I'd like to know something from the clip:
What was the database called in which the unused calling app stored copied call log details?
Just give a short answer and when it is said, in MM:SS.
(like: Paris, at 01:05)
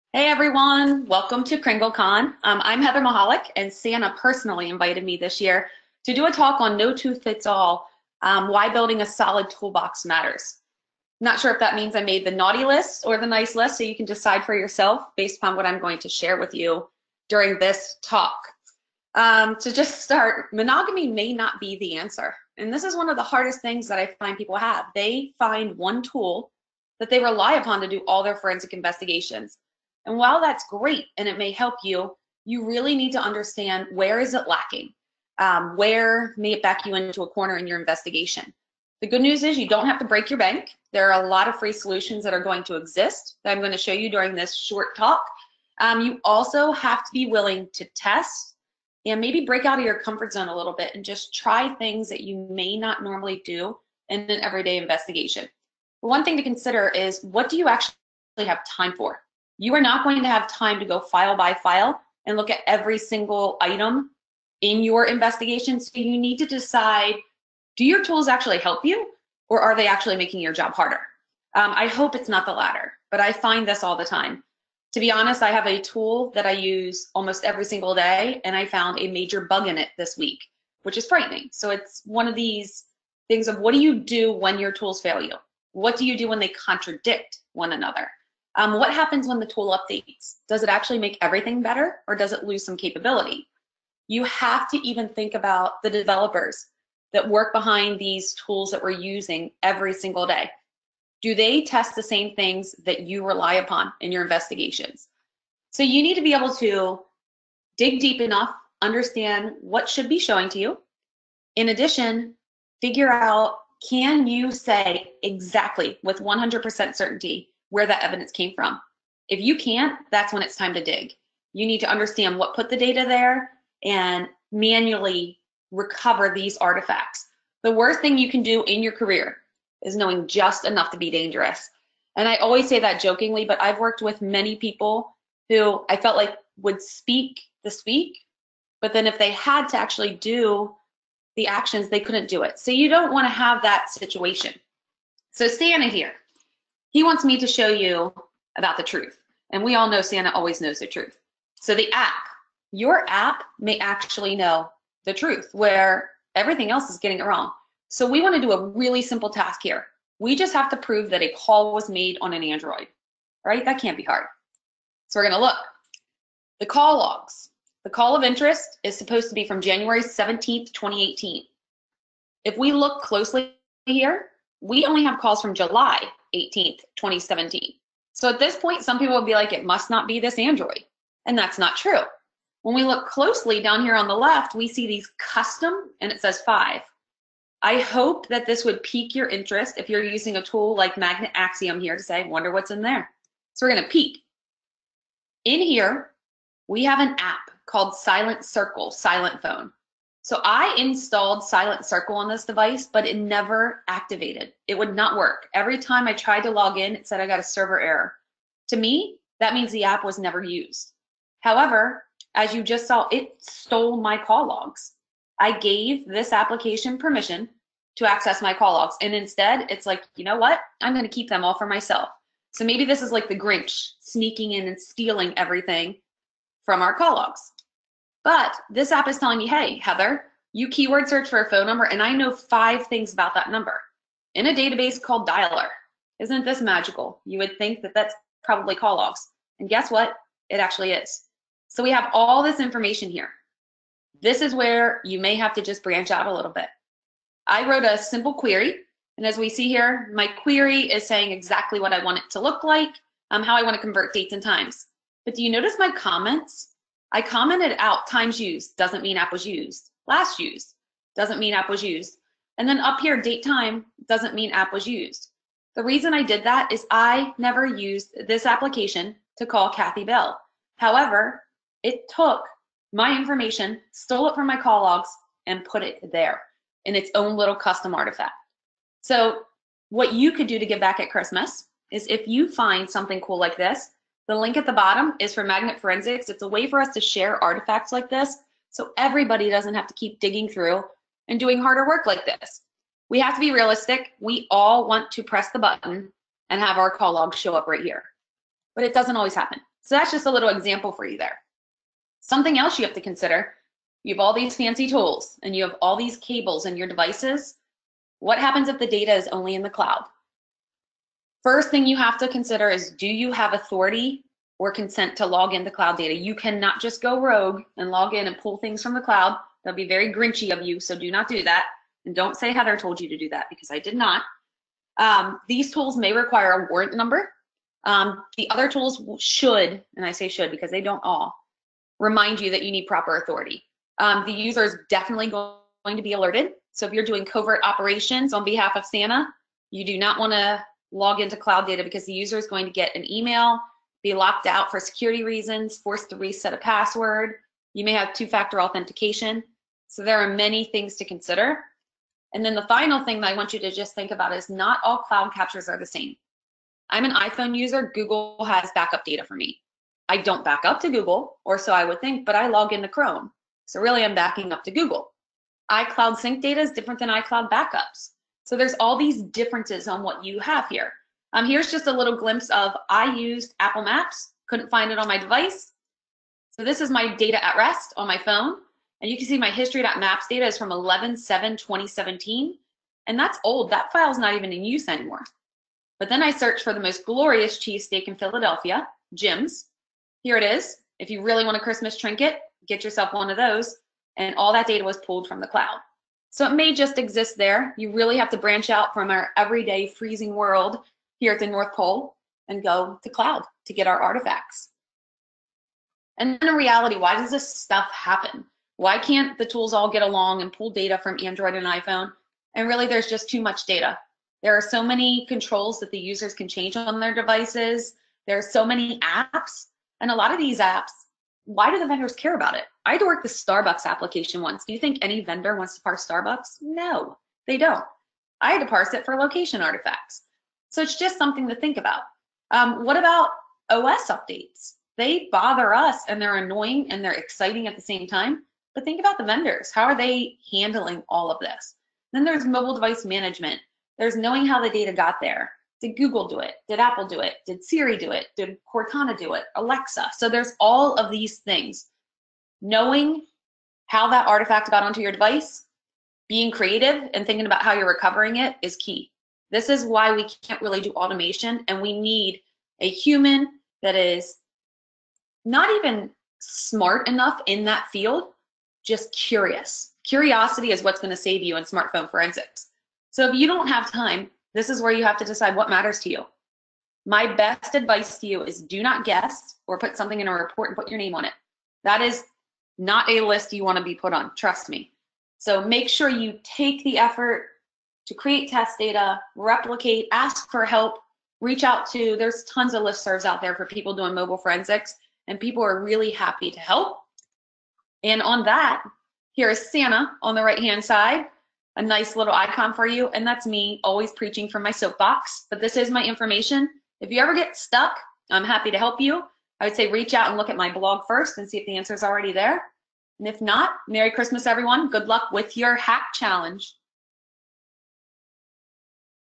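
Dialer, at 03:55.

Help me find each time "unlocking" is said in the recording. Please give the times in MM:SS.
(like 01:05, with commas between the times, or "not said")
not said.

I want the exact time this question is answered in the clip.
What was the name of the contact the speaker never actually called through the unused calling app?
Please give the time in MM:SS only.
04:29.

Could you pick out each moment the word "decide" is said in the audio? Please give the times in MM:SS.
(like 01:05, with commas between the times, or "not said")
00:14, 01:06, 07:55.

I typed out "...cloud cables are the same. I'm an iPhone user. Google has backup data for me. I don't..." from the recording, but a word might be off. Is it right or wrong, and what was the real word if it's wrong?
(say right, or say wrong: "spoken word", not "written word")
wrong: "captures", not "cables".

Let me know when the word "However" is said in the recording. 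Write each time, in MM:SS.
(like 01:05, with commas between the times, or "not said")
03:31, 04:30.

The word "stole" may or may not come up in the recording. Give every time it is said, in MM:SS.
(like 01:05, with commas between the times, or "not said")
03:33, 04:33.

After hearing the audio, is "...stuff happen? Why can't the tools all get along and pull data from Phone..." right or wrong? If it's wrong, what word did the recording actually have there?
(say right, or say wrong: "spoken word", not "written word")
wrong: "Android", not "Phone".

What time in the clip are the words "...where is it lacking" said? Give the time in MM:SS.
00:33.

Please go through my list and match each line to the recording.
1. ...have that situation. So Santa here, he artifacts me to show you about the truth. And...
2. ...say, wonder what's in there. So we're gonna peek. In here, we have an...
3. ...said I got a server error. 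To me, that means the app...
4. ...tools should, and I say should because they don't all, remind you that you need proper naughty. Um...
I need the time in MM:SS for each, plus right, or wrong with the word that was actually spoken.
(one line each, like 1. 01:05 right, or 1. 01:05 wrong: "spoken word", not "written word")
1. 02:23 wrong: "wants", not "artifacts"
2. 03:12 right
3. 03:27 right
4. 05:28 wrong: "authority", not "naughty".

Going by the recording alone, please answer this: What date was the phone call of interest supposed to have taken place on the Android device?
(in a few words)
January 17th, 2018.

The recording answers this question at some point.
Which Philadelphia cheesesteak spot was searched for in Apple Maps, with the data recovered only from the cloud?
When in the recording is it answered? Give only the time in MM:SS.
06:29.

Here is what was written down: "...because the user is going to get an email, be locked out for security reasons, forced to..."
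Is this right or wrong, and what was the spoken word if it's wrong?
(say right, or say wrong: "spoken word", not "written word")
right.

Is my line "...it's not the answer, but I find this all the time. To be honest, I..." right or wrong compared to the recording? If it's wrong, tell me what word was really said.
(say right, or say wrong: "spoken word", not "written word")
wrong: "latter", not "answer".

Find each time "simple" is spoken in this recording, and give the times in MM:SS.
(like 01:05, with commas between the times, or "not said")
02:39, 04:07.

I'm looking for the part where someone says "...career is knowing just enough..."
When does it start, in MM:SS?
02:08.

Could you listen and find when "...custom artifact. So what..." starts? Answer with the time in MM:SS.
04:37.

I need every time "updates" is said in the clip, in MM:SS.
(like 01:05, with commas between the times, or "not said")
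01:29, 07:14.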